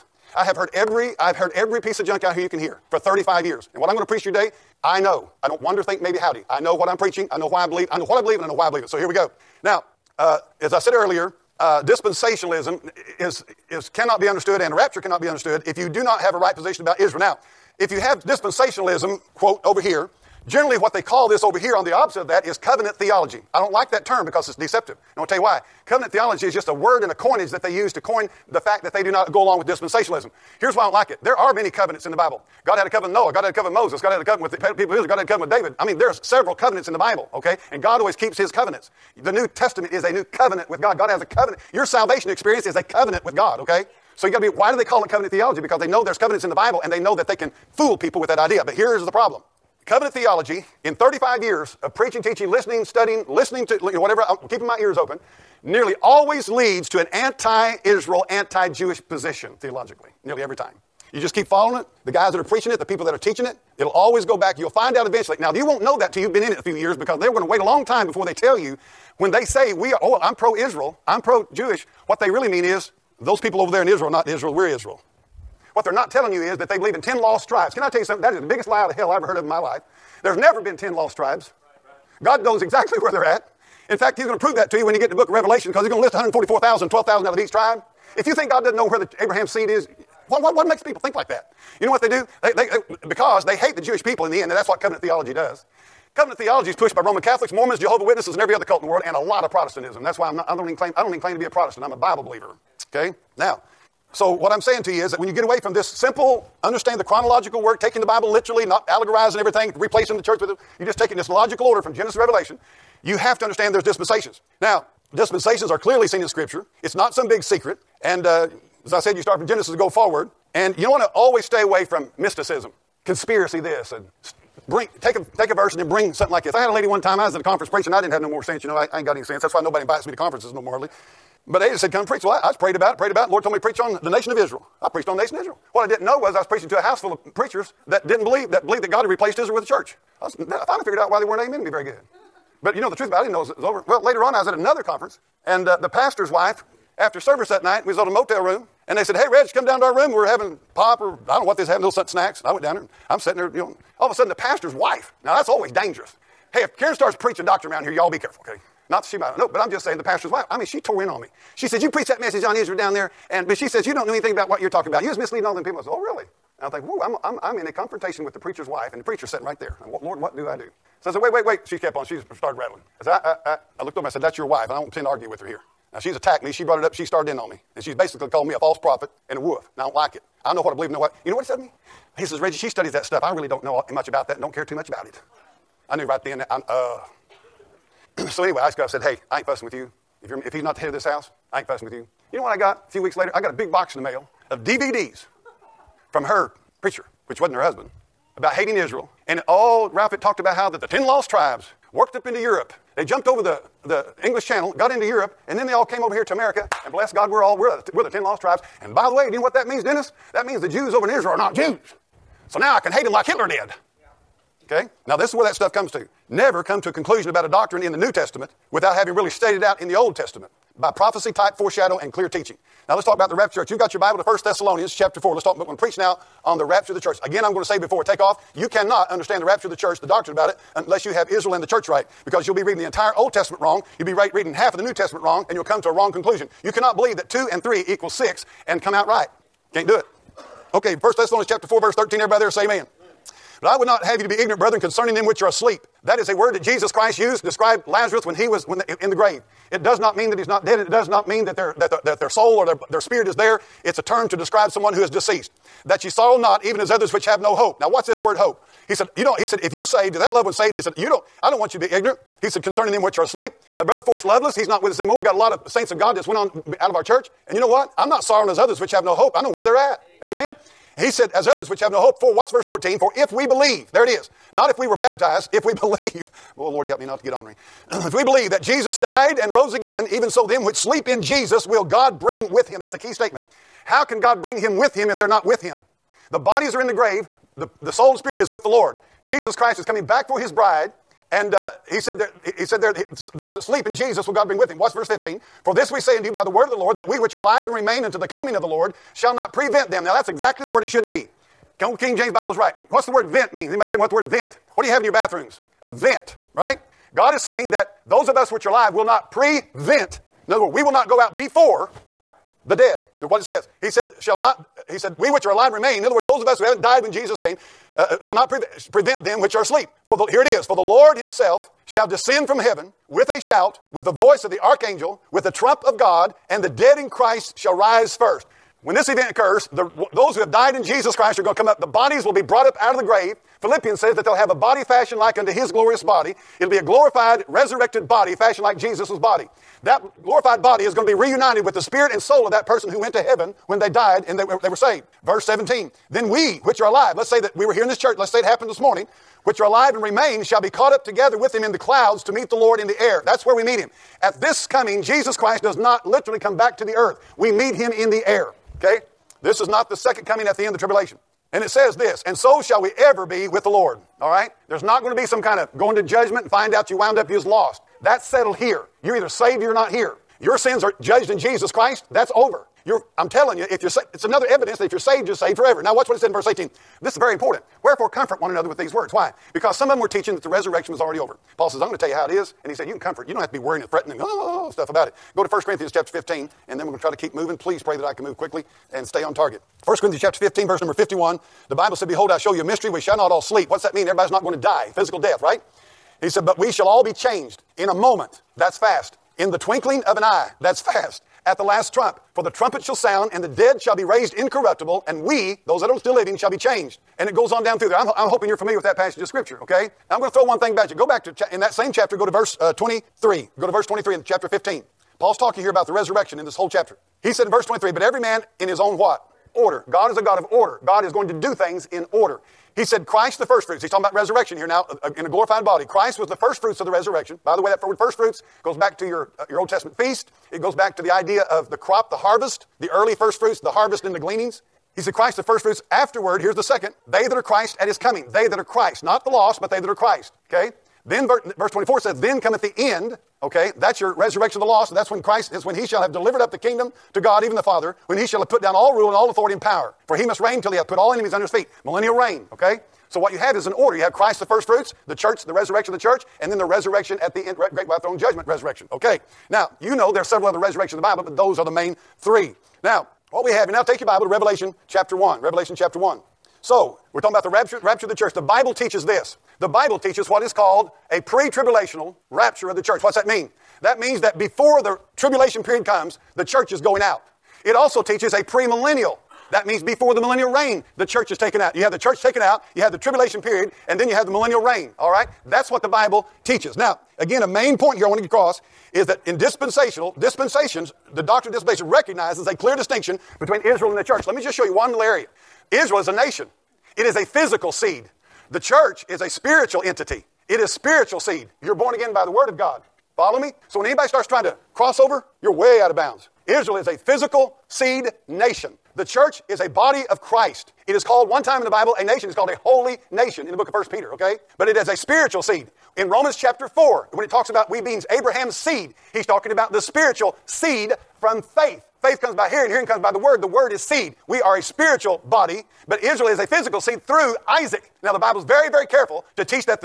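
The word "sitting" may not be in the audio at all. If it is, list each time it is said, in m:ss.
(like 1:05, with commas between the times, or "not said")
2:33, 2:49.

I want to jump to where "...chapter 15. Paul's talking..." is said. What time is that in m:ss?
6:54.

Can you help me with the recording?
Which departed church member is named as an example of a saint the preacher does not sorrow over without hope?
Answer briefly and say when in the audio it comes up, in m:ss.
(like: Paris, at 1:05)
Forrest Loveless, at 4:24.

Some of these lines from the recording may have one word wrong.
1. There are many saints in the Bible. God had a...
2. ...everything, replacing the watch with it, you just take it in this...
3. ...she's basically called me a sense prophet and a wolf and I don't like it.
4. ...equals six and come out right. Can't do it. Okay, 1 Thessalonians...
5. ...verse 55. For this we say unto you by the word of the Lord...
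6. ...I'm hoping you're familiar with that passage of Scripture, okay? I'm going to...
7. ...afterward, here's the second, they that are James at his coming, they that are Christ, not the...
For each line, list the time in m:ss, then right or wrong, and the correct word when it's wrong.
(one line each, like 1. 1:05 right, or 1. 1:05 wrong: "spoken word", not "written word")
1. 0:31 wrong: "covenants", not "saints"
2. 1:49 wrong: "church", not "watch"
3. 2:57 wrong: "false", not "sense"
4. 3:57 right
5. 4:54 wrong: "15", not "55"
6. 6:48 right
7. 7:15 wrong: "Christ", not "James".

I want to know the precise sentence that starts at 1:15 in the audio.
What they're not telling you is that they believe in 10 lost tribes.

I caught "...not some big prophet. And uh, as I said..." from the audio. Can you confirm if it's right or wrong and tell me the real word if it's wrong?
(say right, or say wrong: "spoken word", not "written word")
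wrong: "secret", not "prophet".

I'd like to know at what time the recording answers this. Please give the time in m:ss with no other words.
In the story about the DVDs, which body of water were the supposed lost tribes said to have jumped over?
3:24.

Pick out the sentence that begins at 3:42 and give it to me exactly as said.
Now let's talk about the rapture church.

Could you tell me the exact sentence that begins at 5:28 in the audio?
When this event occurs, the, those who have died in Jesus Christ are going to come up.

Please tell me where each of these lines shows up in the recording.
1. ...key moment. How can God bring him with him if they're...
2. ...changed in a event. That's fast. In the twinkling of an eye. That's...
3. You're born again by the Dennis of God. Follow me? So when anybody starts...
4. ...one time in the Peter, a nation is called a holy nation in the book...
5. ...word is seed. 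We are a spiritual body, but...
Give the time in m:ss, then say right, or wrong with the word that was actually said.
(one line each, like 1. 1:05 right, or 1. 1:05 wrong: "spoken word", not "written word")
1. 4:42 wrong: "statement", not "moment"
2. 6:37 wrong: "moment", not "event"
3. 8:21 wrong: "Word", not "Dennis"
4. 8:31 wrong: "Bible", not "Peter"
5. 8:43 right.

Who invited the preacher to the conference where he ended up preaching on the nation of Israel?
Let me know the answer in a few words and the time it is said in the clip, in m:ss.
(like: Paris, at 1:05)
Ada, at 2:11.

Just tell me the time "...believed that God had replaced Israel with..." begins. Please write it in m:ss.
2:18.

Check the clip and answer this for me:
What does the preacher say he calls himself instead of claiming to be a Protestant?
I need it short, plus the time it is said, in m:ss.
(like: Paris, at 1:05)
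A Bible believer, at 1:41.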